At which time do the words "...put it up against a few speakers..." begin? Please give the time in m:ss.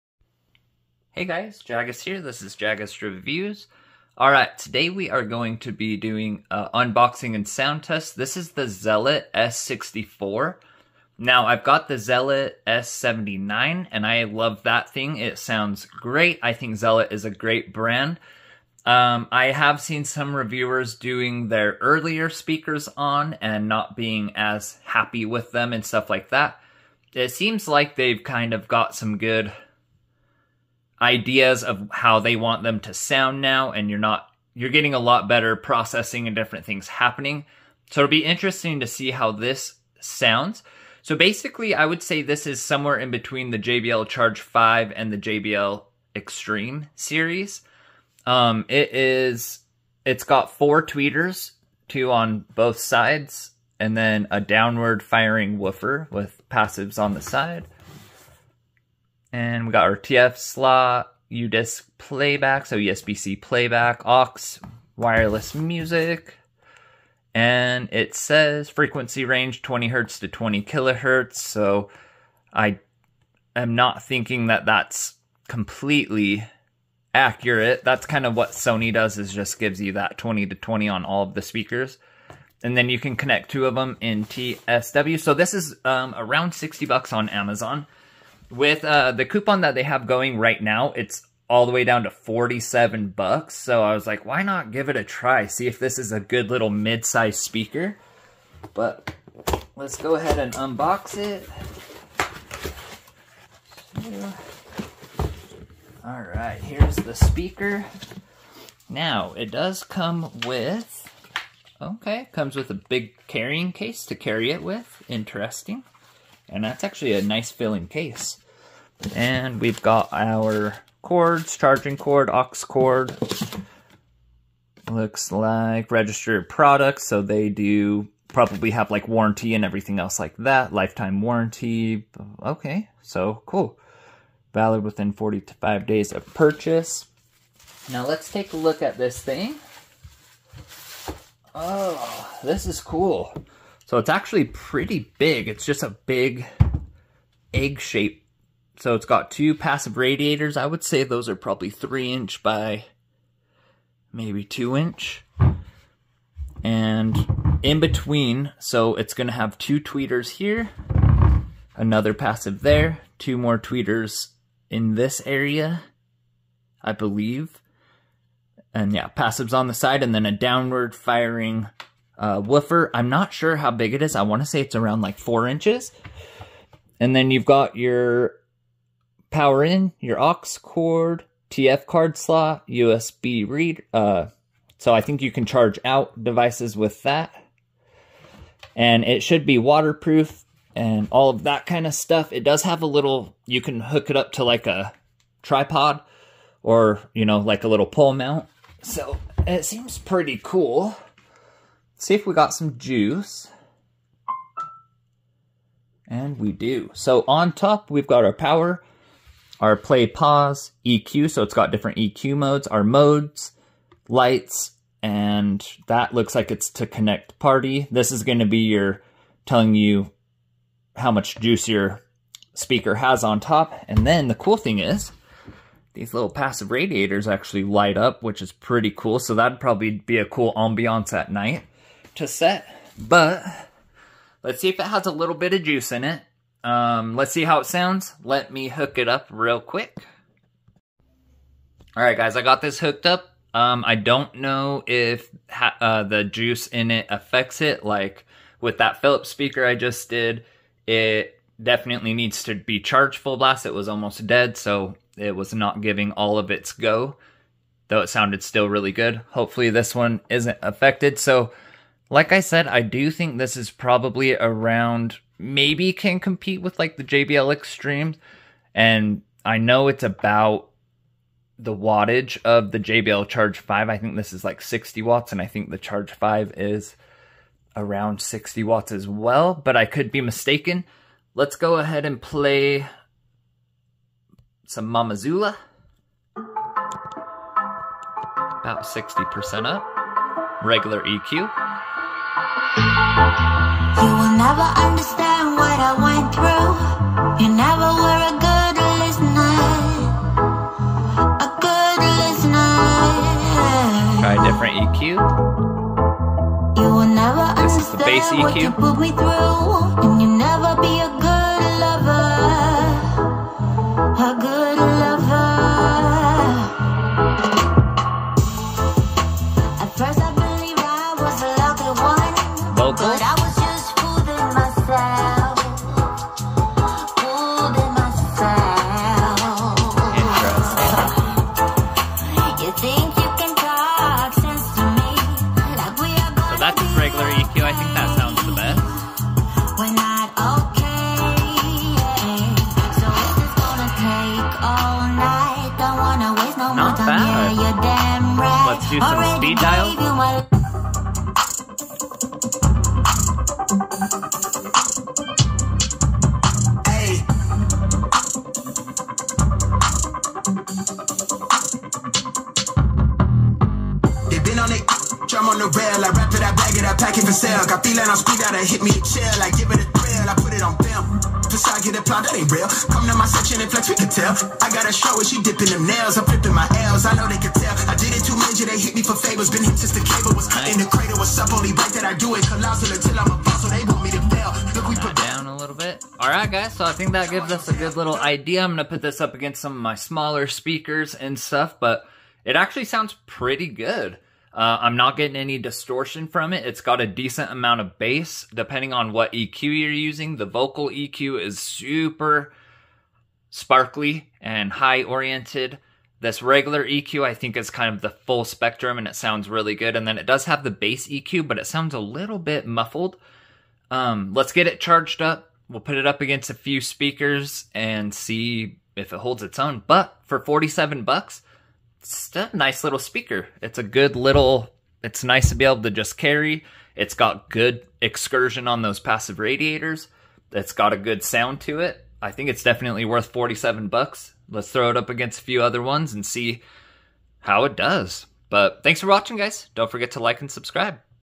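6:55.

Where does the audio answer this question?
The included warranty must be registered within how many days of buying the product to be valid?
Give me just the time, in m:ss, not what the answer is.
2:15.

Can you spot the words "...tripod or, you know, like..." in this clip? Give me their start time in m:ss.
3:15.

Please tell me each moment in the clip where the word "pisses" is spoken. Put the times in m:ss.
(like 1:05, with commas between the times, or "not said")
not said.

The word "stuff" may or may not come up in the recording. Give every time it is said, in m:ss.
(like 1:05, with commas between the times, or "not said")
0:25, 3:11, 6:31.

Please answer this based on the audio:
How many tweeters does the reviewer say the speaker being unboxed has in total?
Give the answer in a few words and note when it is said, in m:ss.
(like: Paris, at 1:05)
4, at 0:50.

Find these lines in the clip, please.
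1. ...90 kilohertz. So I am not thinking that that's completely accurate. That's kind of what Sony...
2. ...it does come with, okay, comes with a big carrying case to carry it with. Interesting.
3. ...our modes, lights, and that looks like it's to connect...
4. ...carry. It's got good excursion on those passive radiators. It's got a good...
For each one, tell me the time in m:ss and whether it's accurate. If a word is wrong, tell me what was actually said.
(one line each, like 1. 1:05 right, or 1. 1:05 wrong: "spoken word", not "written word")
1. 1:10 wrong: "20", not "90"
2. 1:49 right
3. 3:32 right
4. 7:06 right.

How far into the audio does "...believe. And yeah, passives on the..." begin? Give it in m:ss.
2:46.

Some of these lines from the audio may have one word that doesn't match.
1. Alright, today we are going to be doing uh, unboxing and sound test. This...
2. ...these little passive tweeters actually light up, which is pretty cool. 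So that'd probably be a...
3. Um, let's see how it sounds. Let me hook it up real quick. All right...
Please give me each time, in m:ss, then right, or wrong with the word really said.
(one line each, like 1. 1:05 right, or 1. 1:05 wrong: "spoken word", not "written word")
1. 0:04 right
2. 3:45 wrong: "radiators", not "tweeters"
3. 3:56 right.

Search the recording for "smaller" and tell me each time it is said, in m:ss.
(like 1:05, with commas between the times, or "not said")
6:29.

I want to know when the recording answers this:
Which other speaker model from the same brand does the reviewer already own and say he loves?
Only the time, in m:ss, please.
0:11.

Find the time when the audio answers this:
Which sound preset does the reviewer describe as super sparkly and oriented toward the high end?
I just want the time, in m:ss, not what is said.
6:40.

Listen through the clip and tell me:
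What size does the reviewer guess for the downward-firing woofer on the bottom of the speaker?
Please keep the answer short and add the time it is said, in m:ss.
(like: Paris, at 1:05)
4 inches, at 2:55.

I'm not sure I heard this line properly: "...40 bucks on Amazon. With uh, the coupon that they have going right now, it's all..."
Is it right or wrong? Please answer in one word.
wrong.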